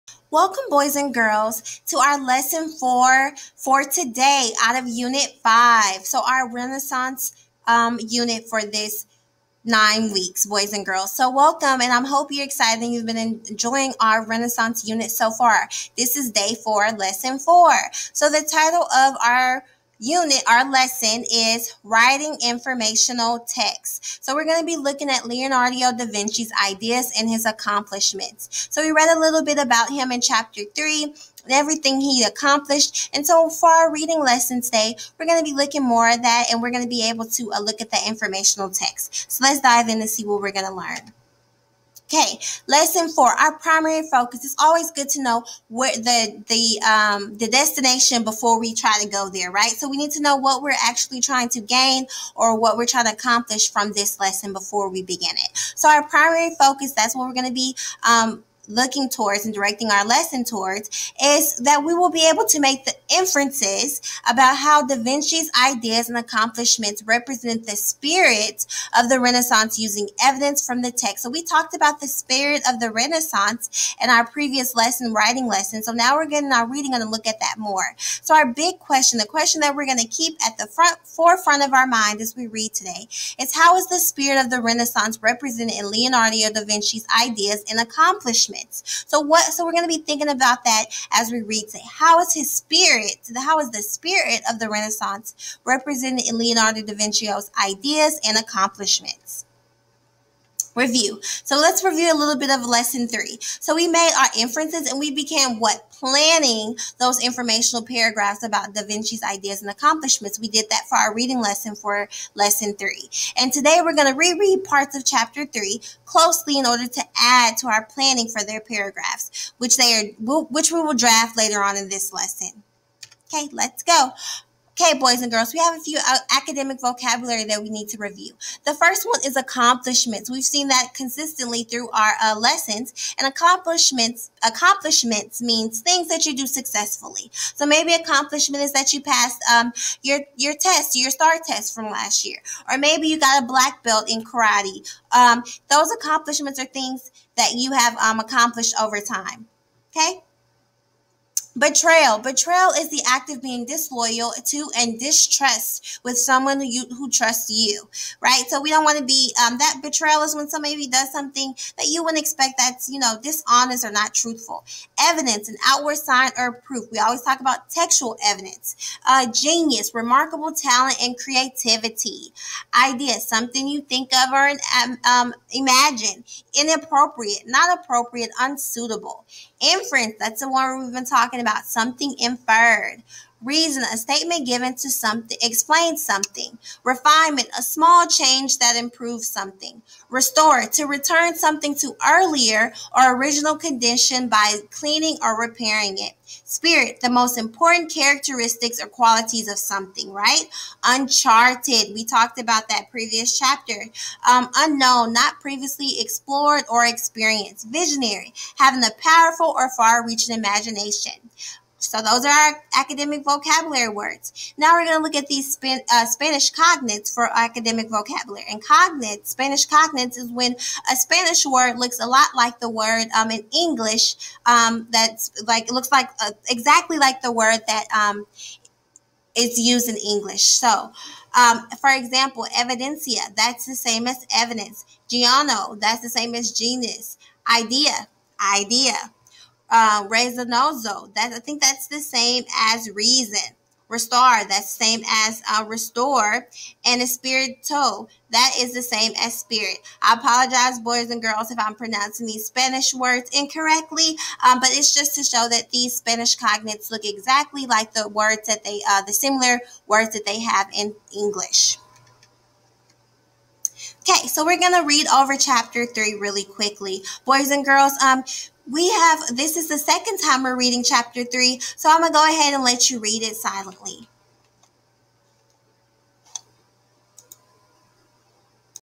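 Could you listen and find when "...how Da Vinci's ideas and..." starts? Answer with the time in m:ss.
1:04.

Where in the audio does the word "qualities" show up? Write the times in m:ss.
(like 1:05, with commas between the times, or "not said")
3:18.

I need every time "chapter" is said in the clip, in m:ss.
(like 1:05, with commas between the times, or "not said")
0:30, 1:55, 3:23, 4:25, 4:30.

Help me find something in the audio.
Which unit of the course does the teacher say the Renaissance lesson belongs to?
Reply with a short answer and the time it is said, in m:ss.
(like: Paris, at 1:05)
Unit 5, at 0:04.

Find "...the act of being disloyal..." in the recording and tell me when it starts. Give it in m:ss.
2:32.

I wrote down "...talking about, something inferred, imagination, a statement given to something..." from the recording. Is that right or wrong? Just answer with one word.
wrong.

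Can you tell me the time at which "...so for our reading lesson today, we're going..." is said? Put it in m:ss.
0:33.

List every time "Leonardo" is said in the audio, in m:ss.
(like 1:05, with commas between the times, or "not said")
0:25, 1:25, 1:36.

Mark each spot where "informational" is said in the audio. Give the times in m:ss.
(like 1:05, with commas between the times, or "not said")
0:22, 0:38, 1:47.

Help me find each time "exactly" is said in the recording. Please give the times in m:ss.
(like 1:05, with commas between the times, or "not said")
3:46, 4:17.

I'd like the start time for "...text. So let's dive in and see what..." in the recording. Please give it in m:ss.
0:38.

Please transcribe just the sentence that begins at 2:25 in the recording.
Um, those accomplishments are things that you have um, accomplished over time.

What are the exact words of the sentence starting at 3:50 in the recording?
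So, um, for example, evidencia, that's the same as evidence.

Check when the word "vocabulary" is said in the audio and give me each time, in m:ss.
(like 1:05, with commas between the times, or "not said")
2:06, 3:33, 3:37.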